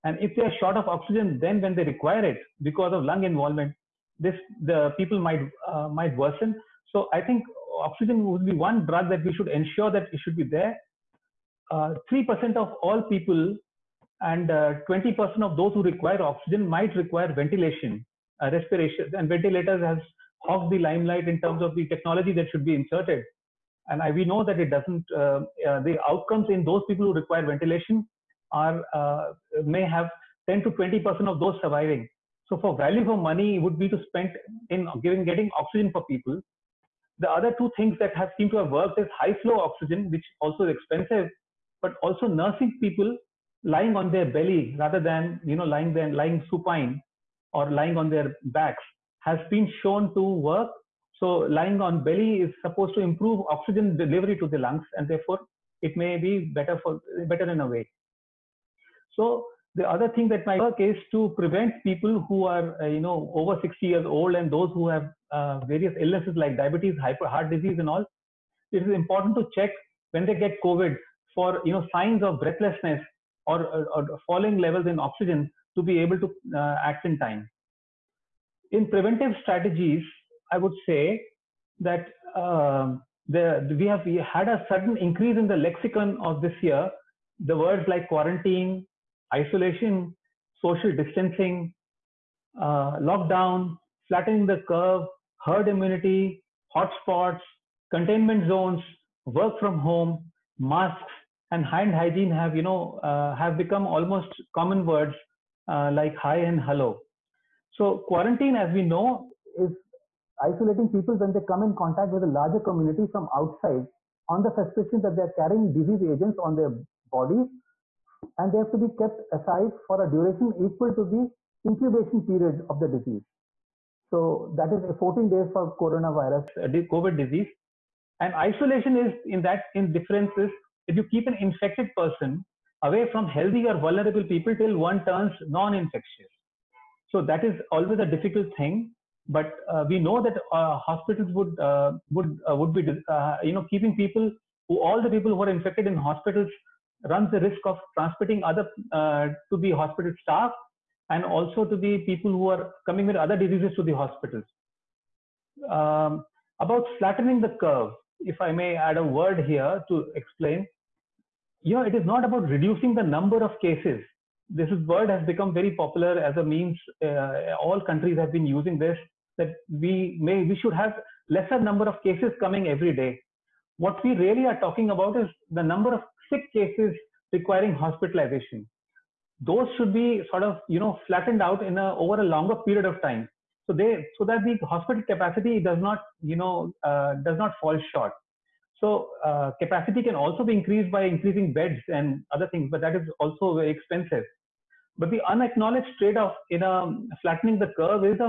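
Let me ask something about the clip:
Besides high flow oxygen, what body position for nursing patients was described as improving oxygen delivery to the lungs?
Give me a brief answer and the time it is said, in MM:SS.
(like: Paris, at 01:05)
Lying on their belly, at 00:43.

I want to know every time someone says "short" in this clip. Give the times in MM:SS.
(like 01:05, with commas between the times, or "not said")
00:00, 03:07.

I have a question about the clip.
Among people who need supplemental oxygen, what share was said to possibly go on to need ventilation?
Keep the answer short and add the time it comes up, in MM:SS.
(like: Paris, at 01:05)
20 percent, at 00:14.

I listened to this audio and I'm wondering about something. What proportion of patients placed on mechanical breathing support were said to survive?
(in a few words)
10 to 20 percent.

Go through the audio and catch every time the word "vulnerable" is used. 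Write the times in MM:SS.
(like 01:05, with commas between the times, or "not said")
02:13.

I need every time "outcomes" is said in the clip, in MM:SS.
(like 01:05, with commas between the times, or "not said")
00:26.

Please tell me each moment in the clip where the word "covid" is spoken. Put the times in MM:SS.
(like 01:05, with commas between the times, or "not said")
01:10, 02:06.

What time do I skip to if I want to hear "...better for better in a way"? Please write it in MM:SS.
00:56.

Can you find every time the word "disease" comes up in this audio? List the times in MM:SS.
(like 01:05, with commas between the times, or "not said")
01:07, 01:55, 02:02, 02:07, 02:33.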